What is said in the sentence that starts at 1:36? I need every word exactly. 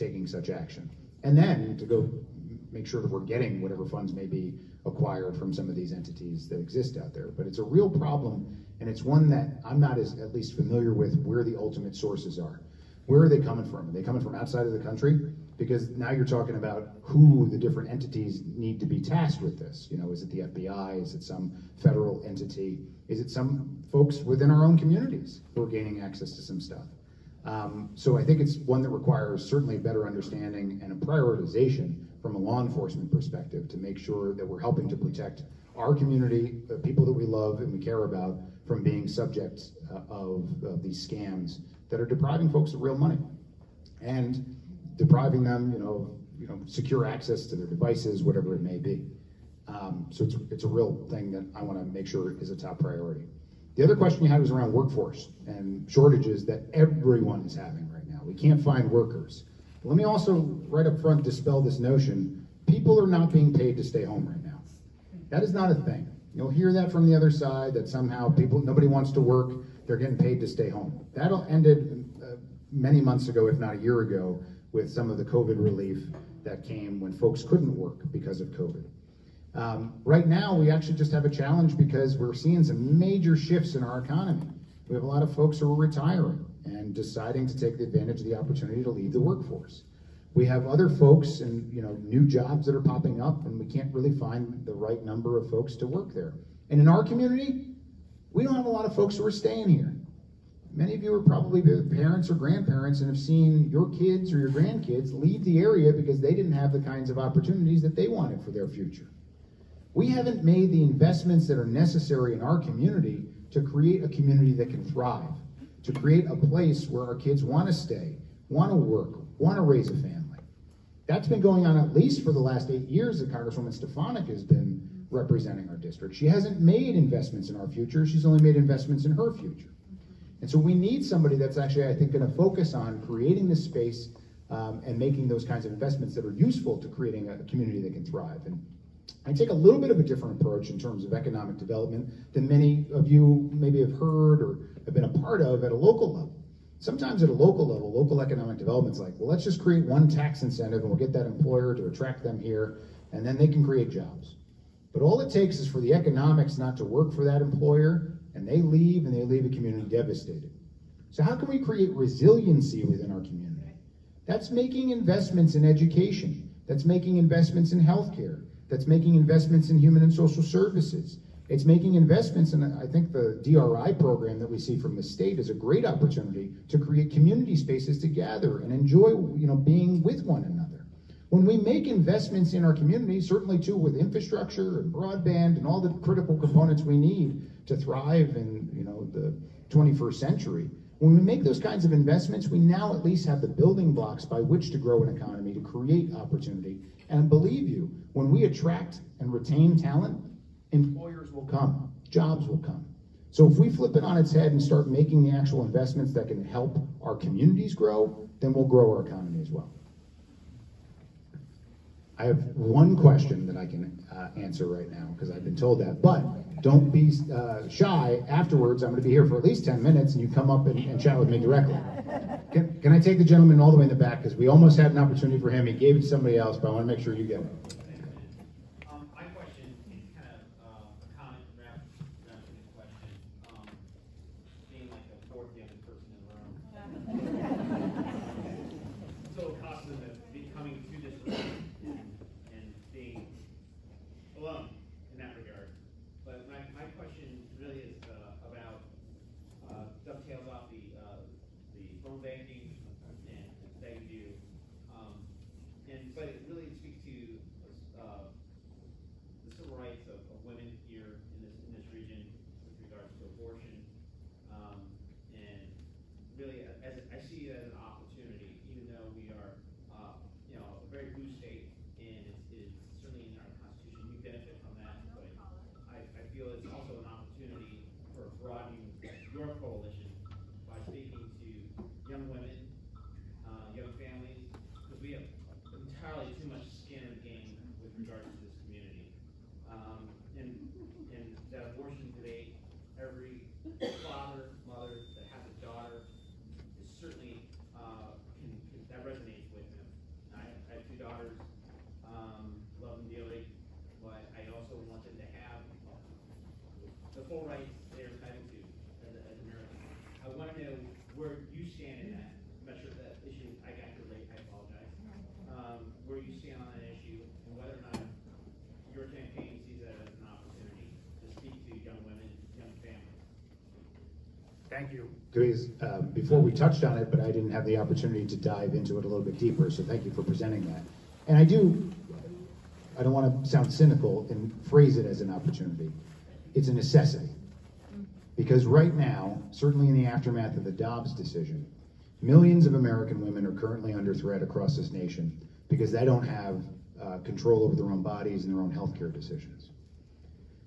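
And in our community, we don't have a lot of folks who are staying here.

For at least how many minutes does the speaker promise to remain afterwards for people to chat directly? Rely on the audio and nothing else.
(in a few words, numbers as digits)
10.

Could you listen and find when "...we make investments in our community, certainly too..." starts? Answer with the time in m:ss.
3:01.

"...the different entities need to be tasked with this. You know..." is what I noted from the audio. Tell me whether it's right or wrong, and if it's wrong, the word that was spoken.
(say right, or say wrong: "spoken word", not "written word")
right.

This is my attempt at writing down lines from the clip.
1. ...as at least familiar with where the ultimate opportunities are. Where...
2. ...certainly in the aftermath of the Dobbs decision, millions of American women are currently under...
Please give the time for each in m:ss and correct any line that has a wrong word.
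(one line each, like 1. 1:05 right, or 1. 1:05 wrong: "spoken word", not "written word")
1. 0:09 wrong: "sources", not "opportunities"
2. 5:39 right.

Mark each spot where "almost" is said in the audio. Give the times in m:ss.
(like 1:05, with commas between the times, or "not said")
3:44.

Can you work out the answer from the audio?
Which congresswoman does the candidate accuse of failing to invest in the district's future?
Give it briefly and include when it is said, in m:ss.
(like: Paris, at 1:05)
Stefanik, at 2:03.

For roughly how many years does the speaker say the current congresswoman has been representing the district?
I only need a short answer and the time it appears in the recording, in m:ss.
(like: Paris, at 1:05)
8, at 2:02.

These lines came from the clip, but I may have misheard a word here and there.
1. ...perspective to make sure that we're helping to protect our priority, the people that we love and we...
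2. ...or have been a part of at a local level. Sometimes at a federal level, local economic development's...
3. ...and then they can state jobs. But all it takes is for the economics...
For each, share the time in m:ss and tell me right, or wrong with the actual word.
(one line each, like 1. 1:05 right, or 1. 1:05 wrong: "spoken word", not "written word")
1. 0:33 wrong: "community", not "priority"
2. 2:24 wrong: "local", not "federal"
3. 2:33 wrong: "create", not "state".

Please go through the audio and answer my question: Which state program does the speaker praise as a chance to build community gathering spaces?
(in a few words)
DRI.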